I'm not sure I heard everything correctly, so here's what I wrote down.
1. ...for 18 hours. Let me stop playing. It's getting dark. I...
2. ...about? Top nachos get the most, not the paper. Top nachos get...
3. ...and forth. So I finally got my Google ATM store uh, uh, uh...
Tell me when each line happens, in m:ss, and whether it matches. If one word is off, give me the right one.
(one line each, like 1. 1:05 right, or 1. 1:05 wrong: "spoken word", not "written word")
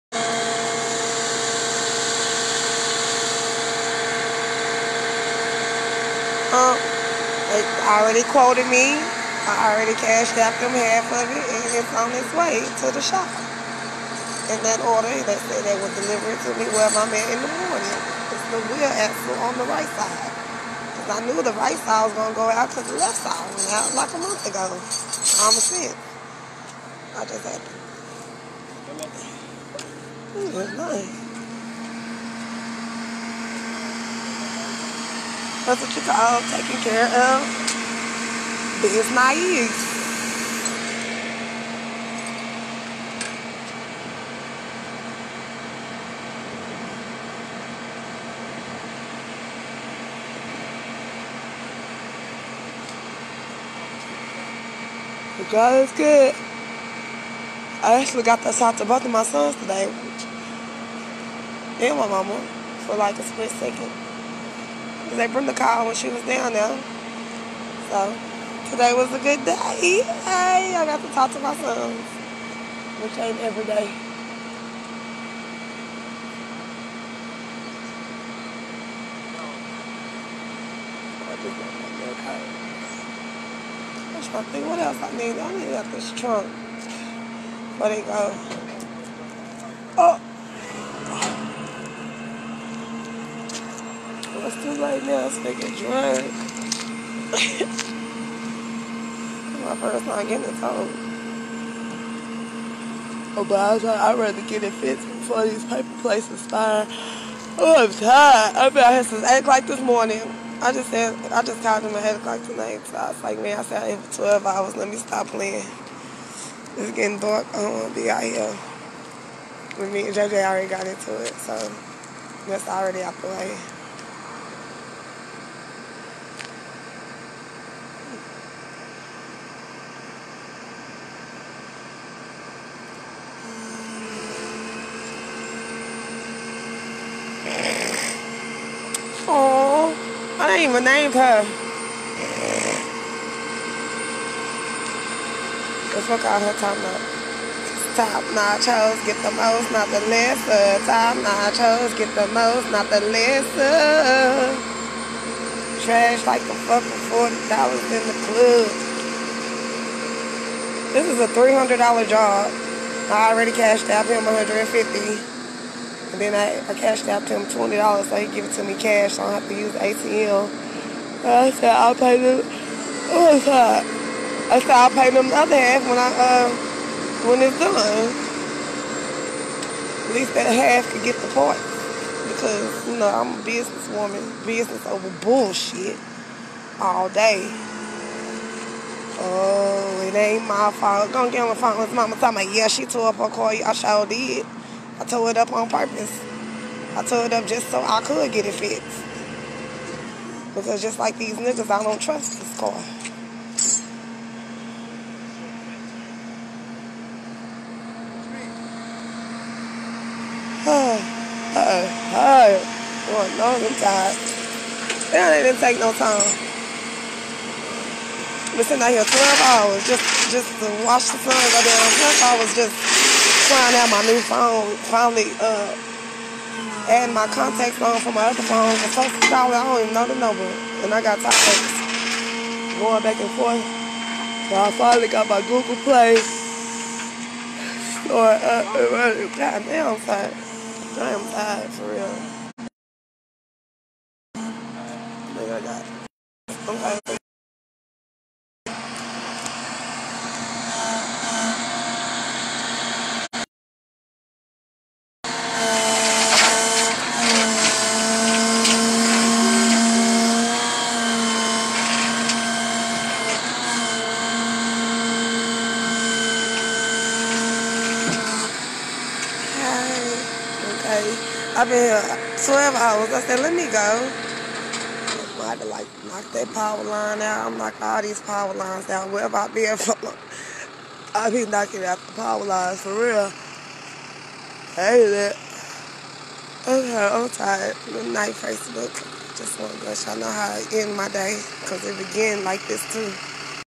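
1. 1:53 wrong: "12", not "18"
2. 2:26 wrong: "lesser", not "paper"
3. 3:53 wrong: "Play", not "ATM".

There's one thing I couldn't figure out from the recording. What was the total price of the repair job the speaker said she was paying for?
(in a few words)
$300.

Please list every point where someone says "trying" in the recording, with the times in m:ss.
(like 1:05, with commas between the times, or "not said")
1:24, 3:43.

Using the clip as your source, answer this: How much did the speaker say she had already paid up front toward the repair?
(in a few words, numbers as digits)
$150.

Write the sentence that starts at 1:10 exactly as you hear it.
Hey, I got to talk to my sons, which ain't every day.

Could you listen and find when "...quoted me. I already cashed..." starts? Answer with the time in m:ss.
0:08.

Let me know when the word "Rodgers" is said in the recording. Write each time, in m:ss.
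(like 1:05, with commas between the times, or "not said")
not said.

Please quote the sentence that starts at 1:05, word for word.
Because they burned the car when she was down there.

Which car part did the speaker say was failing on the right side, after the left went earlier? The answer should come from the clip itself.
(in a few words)
wheel axle.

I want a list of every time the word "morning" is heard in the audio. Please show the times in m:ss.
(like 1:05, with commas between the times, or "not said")
0:17, 1:49.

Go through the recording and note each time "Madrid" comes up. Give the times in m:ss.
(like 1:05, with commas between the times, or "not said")
not said.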